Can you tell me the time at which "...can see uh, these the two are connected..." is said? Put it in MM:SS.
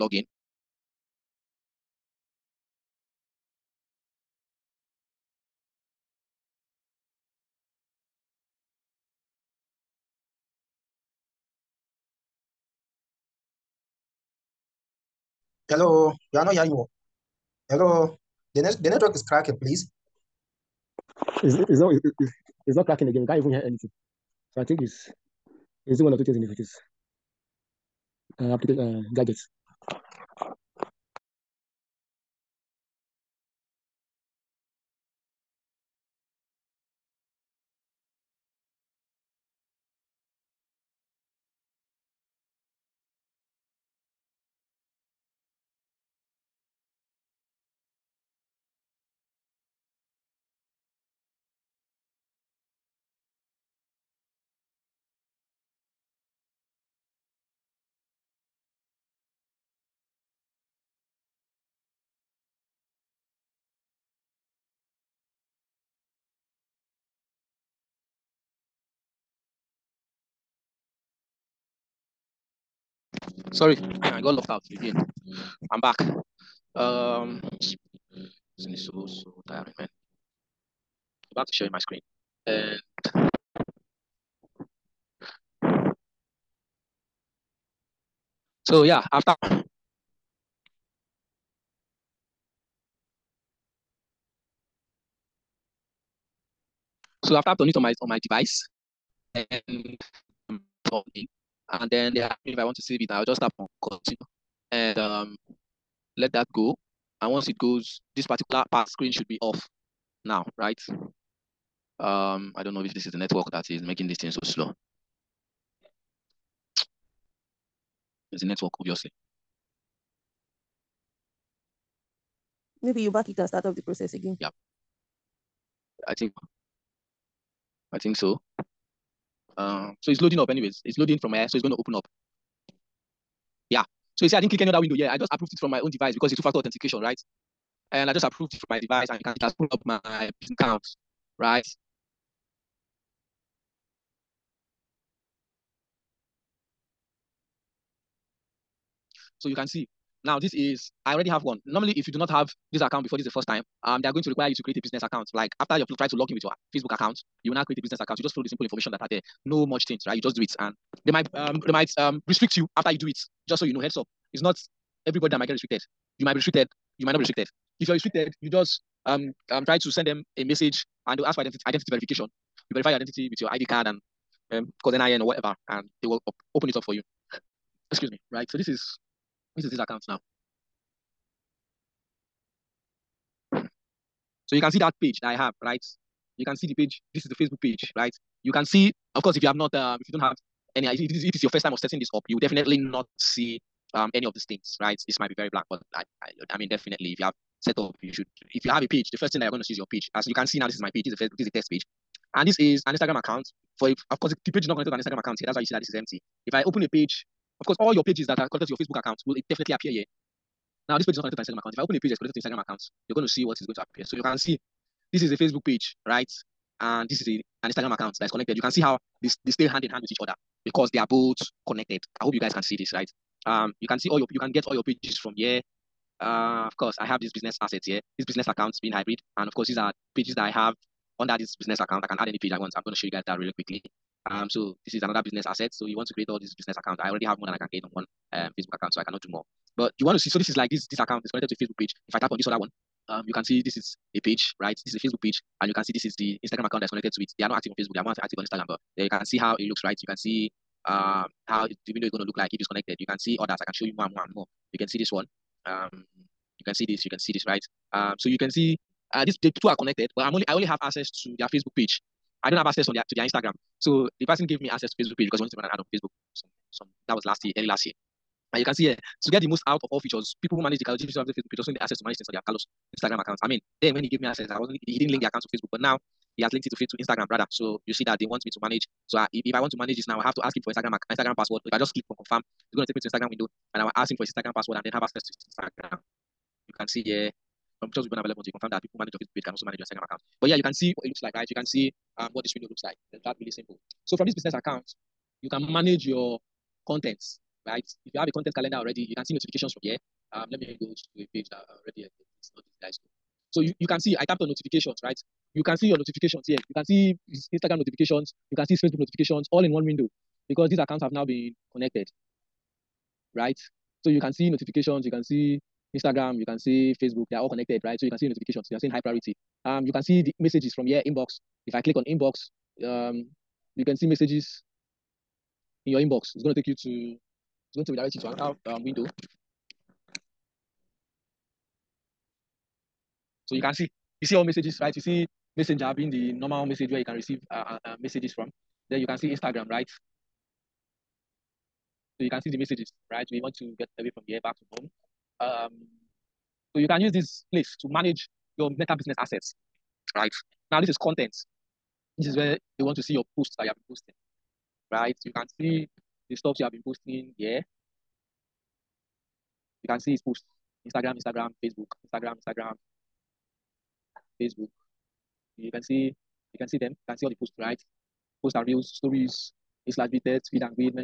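04:18.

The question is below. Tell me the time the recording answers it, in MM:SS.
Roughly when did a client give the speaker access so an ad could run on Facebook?
04:27.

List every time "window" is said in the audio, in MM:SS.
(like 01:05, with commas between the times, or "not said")
02:14, 04:11, 04:43, 04:52, 05:09, 05:28.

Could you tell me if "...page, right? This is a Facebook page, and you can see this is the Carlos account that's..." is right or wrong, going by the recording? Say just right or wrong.
wrong.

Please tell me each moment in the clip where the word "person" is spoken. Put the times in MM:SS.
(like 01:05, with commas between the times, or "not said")
04:24.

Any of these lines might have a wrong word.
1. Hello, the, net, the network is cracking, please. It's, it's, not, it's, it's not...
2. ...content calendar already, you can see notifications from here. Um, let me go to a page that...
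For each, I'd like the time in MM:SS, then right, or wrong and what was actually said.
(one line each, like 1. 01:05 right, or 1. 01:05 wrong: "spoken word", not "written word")
1. 00:17 right
2. 04:58 right.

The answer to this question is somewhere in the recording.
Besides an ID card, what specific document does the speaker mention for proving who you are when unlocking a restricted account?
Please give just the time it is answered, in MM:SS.
02:54.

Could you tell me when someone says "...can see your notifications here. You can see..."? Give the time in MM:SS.
05:05.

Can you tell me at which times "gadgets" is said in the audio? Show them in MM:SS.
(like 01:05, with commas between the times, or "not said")
00:29.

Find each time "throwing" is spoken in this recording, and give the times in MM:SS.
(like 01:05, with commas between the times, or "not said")
not said.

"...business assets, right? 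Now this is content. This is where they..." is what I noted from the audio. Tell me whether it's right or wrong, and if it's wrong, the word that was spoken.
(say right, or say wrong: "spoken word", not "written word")
right.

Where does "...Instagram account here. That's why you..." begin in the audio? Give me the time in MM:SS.
03:24.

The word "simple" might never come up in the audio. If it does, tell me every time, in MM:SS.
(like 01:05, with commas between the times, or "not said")
02:38, 04:53.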